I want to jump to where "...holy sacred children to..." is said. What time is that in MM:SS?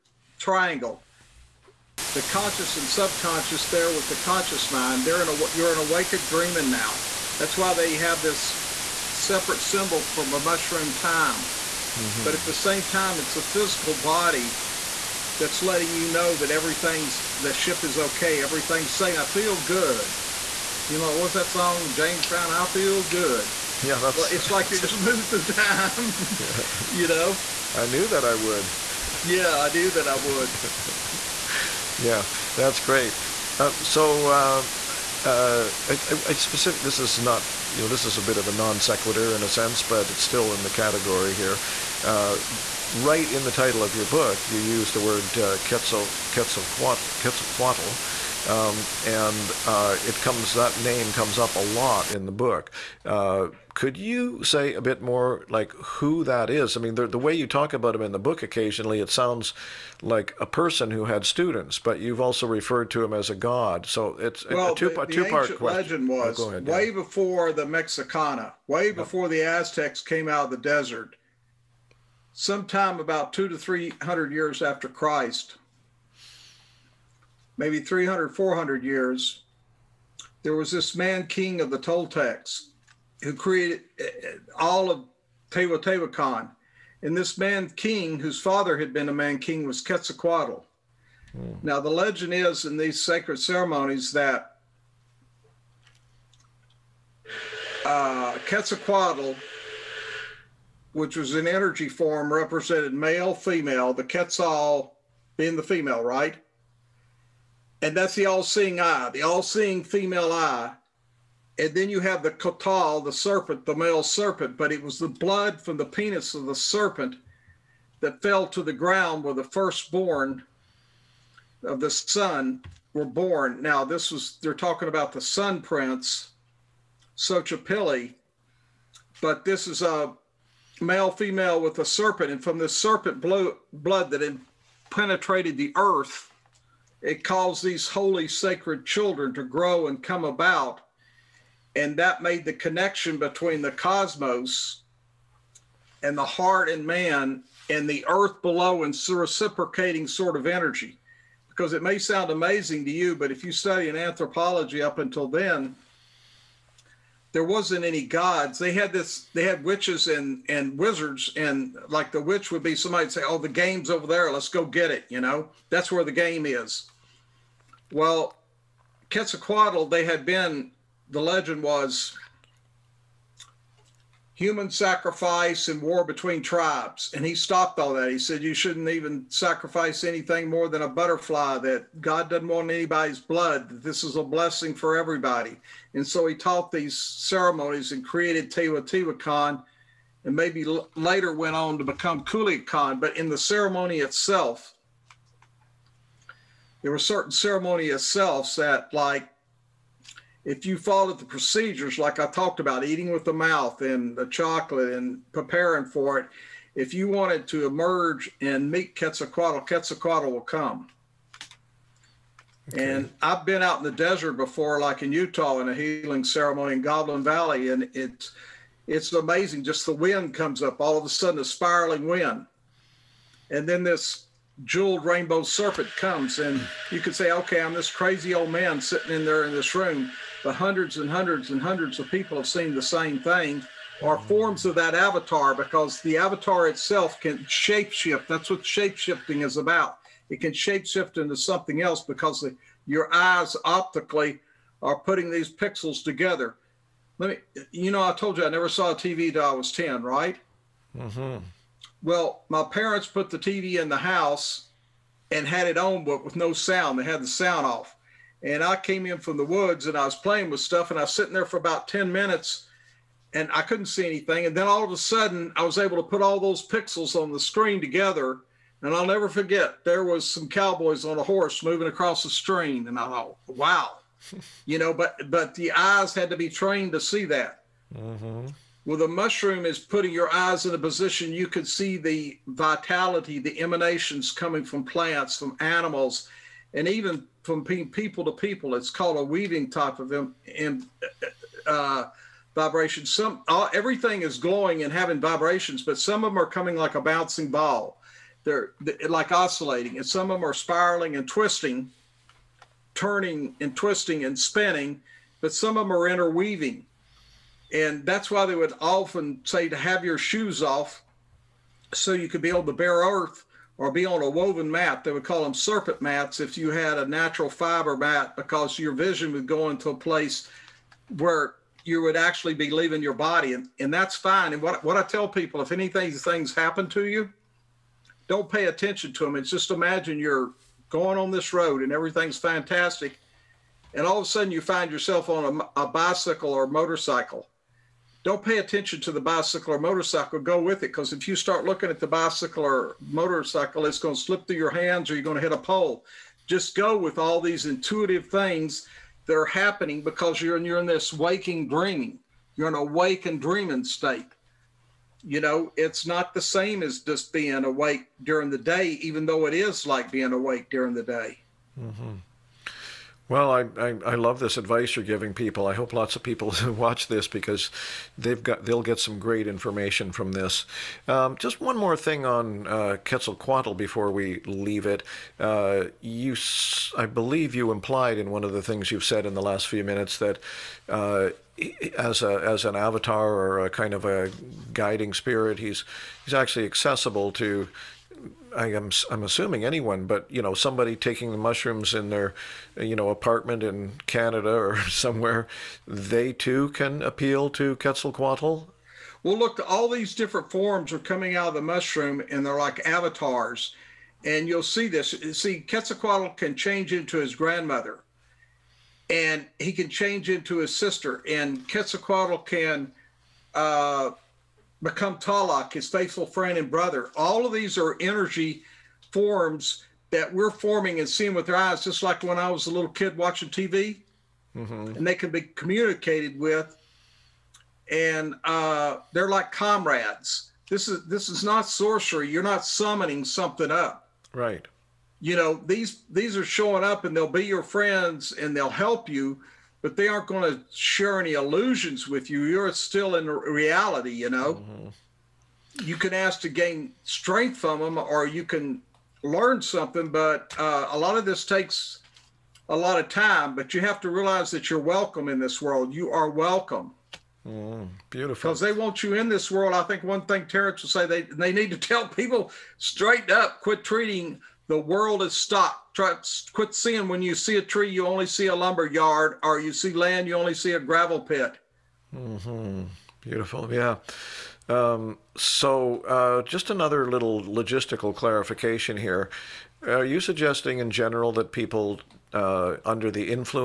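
02:17.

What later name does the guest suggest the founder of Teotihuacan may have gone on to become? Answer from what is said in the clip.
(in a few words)
Kukulcan.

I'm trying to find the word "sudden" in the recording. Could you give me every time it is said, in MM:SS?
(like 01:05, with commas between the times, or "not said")
03:41, 04:24, 05:34.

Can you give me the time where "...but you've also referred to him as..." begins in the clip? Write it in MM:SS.
01:01.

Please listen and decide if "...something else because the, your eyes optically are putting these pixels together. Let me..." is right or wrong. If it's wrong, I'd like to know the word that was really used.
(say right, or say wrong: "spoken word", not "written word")
right.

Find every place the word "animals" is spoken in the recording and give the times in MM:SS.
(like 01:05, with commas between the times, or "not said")
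04:45.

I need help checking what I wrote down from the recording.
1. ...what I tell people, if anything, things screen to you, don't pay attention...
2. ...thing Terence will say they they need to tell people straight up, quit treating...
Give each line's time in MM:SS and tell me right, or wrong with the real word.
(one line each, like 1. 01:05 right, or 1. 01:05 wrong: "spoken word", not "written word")
1. 05:24 wrong: "happen", not "screen"
2. 07:40 right.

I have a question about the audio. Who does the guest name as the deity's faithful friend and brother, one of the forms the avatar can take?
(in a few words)
Talak.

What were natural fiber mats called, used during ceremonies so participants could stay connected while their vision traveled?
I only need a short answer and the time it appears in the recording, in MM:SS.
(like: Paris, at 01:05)
Serpent mats, at 05:15.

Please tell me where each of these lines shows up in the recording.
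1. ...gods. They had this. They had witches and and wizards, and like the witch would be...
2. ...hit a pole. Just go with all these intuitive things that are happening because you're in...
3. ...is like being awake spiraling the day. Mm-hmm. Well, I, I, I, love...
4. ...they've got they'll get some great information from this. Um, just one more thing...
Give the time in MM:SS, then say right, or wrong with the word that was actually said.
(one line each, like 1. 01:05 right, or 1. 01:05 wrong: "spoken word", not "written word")
1. 02:38 right
2. 05:45 right
3. 05:59 wrong: "during", not "spiraling"
4. 06:08 right.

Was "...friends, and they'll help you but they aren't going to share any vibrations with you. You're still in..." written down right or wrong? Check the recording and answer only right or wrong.
wrong.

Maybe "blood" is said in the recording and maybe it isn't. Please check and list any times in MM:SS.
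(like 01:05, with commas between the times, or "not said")
01:55, 02:13, 03:03.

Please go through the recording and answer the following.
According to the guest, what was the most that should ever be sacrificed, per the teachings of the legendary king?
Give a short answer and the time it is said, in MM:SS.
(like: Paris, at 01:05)
A butterfly, at 03:00.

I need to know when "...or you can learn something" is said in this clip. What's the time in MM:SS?
07:27.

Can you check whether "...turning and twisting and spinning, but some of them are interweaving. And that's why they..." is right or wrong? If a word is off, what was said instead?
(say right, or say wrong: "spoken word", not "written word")
right.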